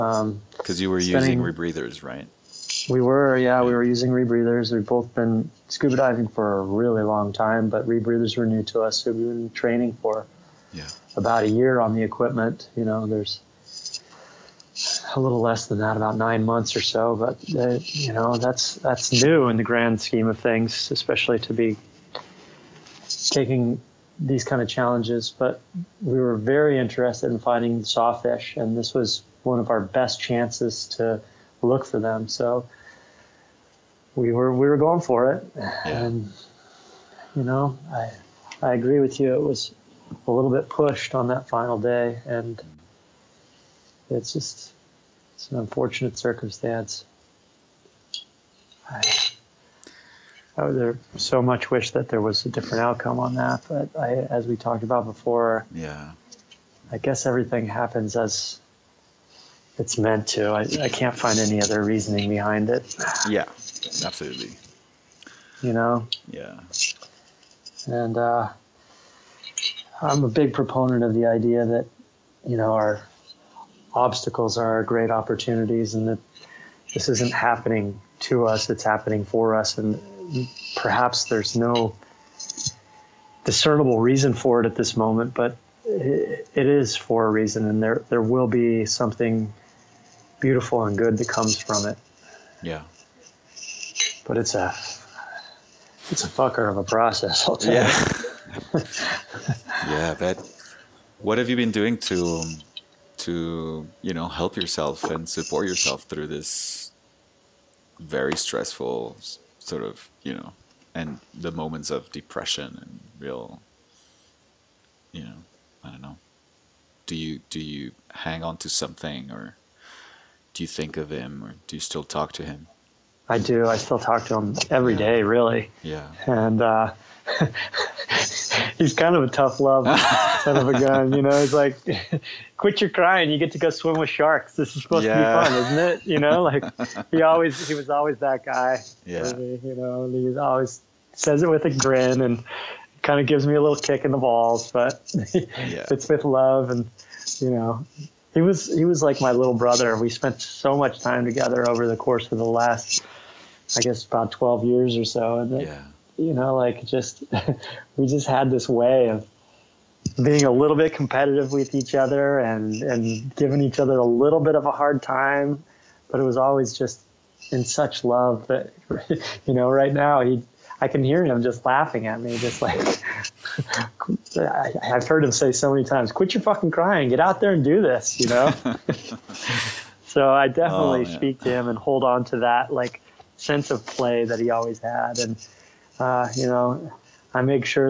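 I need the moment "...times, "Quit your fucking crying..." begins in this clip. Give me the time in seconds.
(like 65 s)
175 s.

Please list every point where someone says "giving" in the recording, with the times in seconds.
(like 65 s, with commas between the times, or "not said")
163 s.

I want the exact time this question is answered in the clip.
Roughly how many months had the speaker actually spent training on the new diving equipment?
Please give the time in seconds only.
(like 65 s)
16 s.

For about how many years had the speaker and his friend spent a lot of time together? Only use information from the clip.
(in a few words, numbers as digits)
12 years.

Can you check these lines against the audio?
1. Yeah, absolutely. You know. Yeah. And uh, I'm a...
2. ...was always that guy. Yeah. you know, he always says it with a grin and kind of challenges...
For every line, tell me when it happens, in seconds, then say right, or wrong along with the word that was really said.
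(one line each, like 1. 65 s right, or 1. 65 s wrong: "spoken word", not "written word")
1. 63 s right
2. 137 s wrong: "gives", not "challenges".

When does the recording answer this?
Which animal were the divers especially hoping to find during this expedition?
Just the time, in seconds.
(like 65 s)
27 s.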